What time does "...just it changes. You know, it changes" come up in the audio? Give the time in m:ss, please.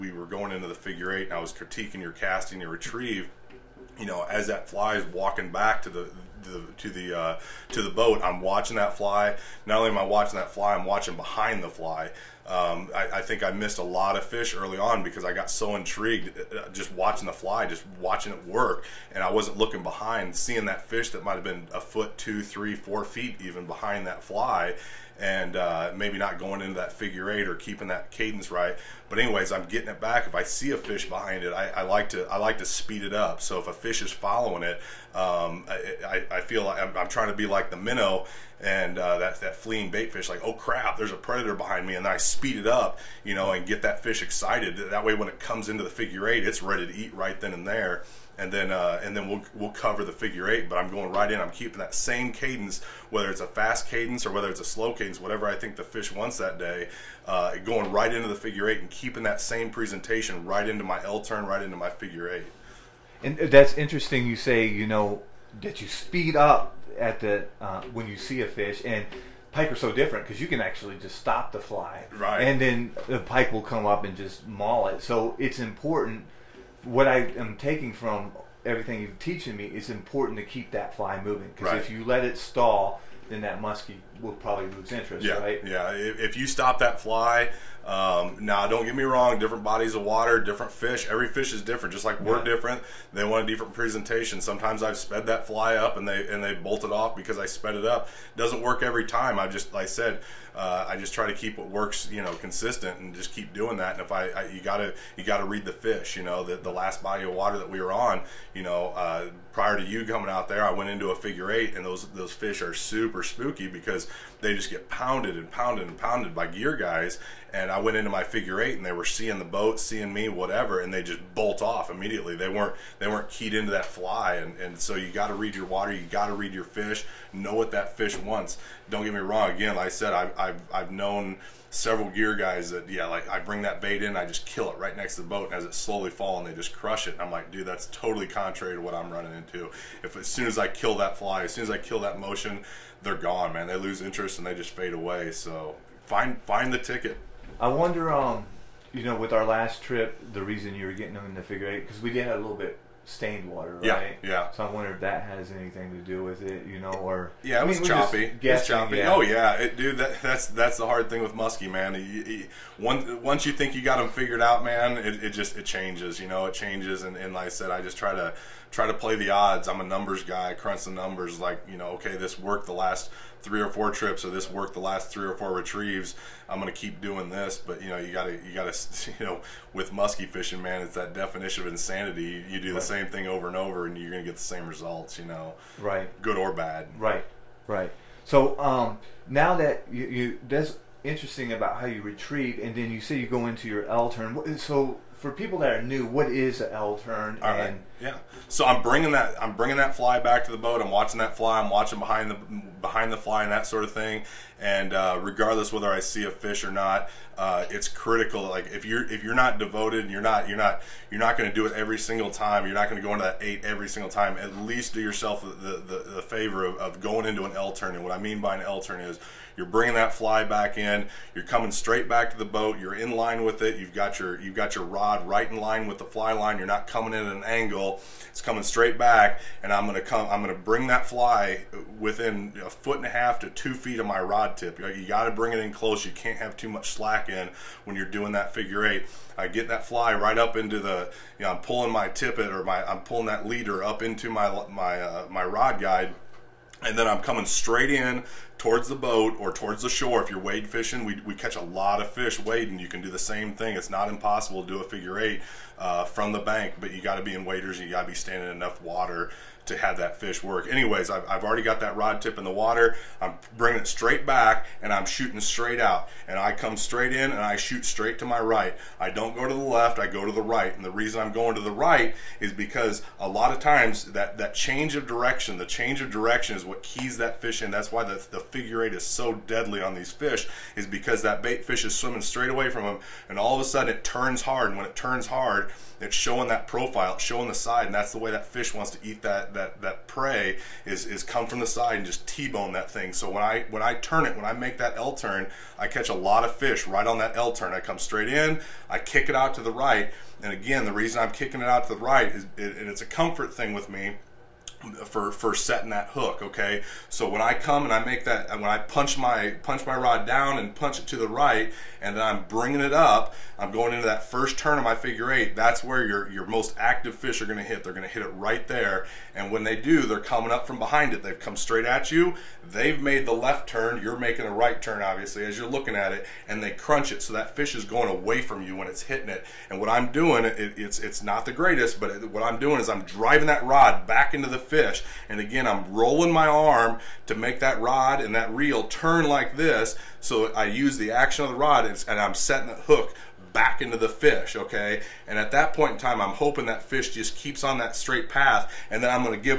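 2:45.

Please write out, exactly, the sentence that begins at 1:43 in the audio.
And if I, I you gotta you gotta read the fish.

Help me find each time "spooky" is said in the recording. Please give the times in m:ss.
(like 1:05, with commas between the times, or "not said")
1:53.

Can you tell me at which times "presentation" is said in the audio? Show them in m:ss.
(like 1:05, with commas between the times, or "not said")
0:59, 1:33.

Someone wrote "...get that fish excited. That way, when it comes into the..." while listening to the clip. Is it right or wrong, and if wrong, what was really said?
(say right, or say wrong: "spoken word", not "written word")
right.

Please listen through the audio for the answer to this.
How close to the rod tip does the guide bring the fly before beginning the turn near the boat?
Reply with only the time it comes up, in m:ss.
3:51.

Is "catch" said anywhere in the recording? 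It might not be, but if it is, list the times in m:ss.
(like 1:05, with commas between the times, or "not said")
4:11, 4:55.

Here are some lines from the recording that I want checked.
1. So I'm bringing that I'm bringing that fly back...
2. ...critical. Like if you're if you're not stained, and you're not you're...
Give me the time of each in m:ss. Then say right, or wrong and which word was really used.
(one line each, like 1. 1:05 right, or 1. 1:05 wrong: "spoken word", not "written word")
1. 3:18 right
2. 3:27 wrong: "devoted", not "stained".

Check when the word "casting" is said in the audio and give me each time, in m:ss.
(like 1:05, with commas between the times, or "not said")
0:02.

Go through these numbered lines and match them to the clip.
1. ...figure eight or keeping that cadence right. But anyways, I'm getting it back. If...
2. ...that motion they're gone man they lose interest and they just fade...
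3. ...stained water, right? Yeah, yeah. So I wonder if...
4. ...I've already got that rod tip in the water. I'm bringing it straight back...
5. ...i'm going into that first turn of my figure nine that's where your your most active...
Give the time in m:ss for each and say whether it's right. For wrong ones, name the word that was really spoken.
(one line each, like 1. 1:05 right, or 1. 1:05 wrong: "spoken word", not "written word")
1. 0:26 right
2. 2:21 right
3. 2:33 right
4. 4:21 right
5. 5:13 wrong: "eight", not "nine".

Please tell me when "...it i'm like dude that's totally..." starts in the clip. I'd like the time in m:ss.
2:17.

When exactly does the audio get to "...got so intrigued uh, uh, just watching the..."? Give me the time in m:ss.
0:15.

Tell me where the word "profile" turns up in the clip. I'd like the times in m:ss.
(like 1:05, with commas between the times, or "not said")
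4:46.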